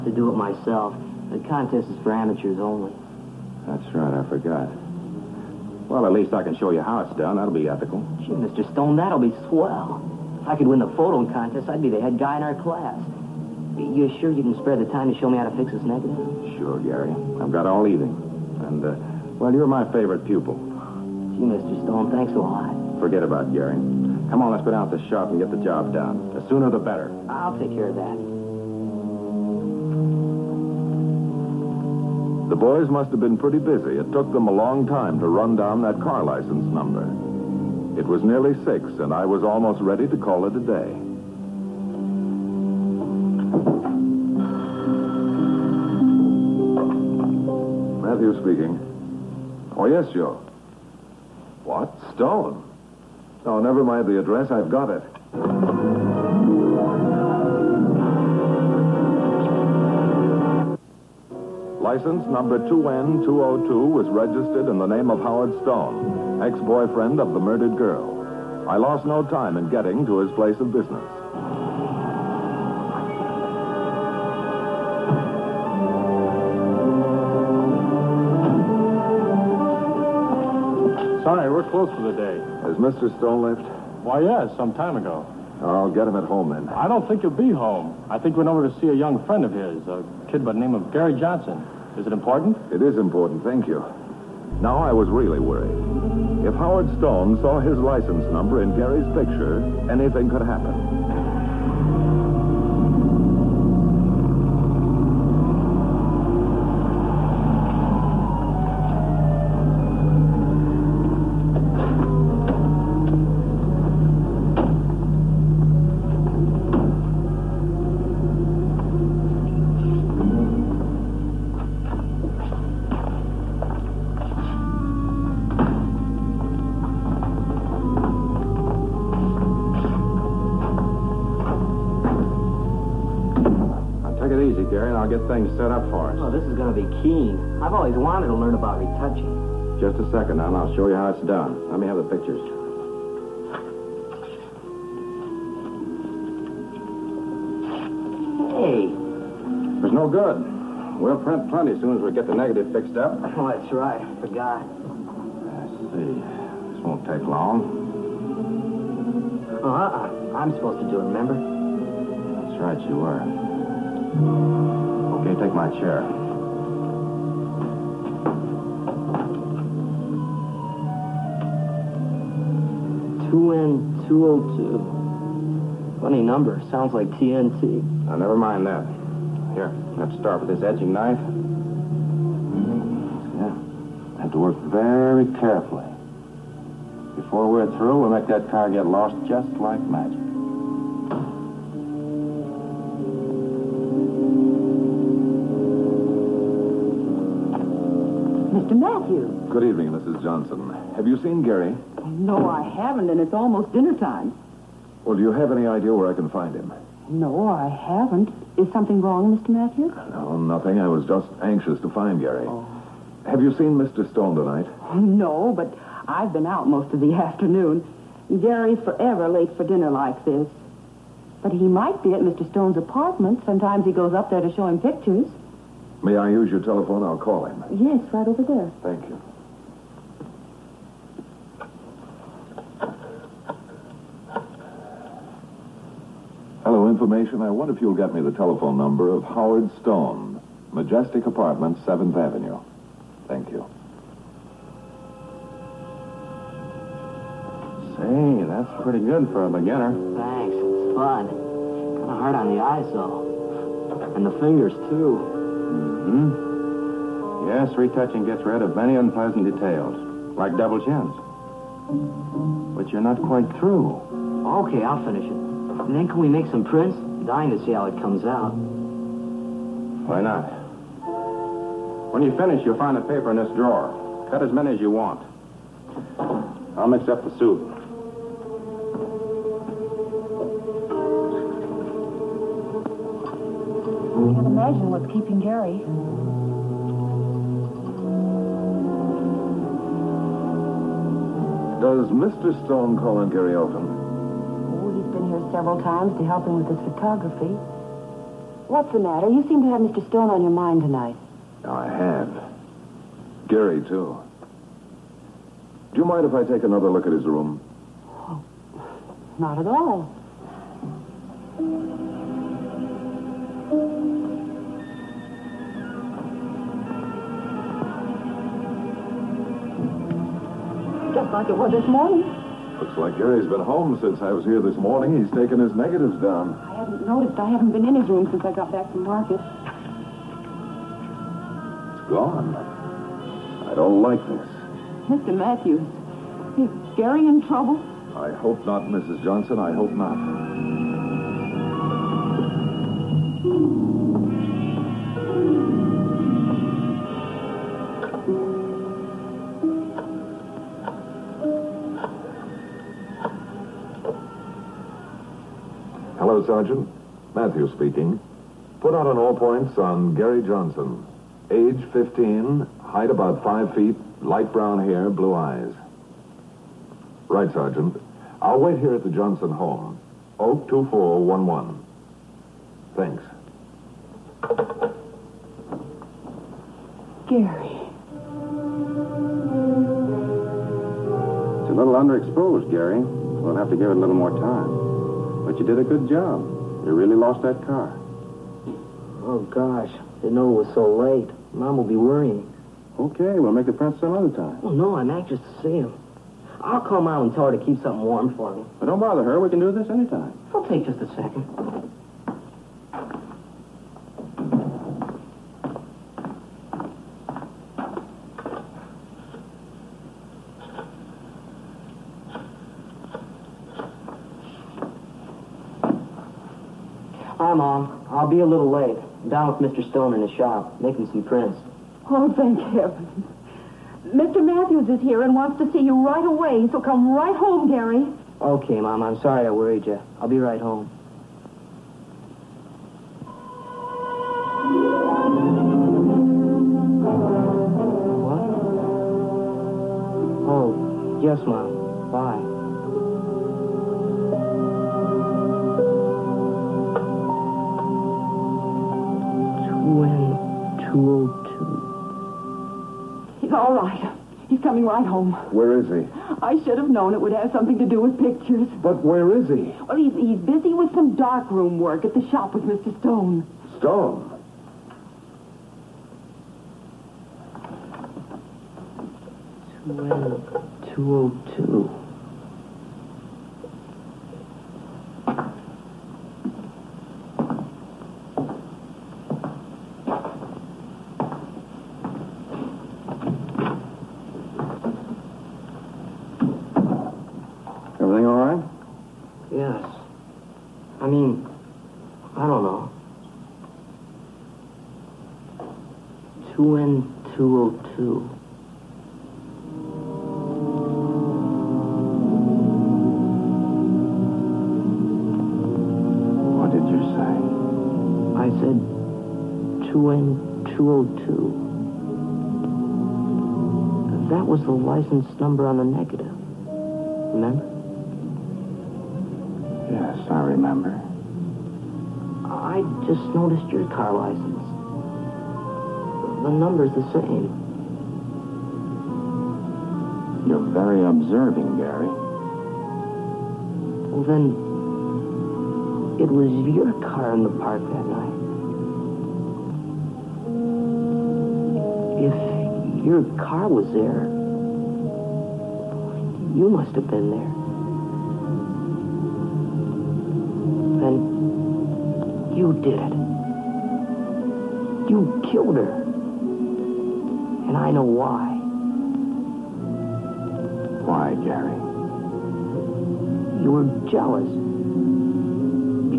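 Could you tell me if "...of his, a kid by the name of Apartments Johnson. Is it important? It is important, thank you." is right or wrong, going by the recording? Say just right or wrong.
wrong.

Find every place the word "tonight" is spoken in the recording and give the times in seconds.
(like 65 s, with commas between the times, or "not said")
214 s, 300 s.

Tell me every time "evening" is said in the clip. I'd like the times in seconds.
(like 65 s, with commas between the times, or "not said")
17 s, 199 s.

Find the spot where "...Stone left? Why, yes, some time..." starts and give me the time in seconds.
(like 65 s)
83 s.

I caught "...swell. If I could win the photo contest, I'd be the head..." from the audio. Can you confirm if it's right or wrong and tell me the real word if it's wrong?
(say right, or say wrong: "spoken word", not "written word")
right.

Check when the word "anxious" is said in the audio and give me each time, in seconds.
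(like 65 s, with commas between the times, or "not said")
211 s, 395 s.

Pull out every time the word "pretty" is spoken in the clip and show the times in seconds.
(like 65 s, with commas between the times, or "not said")
33 s, 248 s.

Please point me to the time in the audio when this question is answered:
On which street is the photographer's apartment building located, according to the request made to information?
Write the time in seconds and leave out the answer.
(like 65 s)
241 s.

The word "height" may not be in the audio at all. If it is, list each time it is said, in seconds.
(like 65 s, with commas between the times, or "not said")
362 s.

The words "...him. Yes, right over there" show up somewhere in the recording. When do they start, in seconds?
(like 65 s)
227 s.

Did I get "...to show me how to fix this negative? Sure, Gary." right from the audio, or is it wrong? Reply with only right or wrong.
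right.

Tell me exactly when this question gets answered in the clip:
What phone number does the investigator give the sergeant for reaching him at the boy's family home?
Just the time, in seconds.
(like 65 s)
370 s.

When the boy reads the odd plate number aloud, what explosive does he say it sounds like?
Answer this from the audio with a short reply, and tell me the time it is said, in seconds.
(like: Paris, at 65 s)
TNT, at 177 s.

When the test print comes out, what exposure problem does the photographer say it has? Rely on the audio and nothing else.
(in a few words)
Underexposed.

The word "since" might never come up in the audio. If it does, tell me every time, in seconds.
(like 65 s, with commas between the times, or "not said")
324 s, 328 s.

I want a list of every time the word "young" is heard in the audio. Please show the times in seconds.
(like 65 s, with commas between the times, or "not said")
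88 s.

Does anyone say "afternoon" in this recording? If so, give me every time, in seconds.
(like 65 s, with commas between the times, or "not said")
217 s.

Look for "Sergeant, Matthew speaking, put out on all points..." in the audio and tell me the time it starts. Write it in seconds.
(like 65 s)
356 s.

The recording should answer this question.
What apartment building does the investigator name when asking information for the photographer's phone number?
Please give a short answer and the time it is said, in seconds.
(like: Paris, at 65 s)
Majestic Apartments, at 240 s.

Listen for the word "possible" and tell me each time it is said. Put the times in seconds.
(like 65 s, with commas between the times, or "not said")
not said.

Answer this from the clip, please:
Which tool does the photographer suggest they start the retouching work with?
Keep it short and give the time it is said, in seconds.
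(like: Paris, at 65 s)
Edging knife, at 180 s.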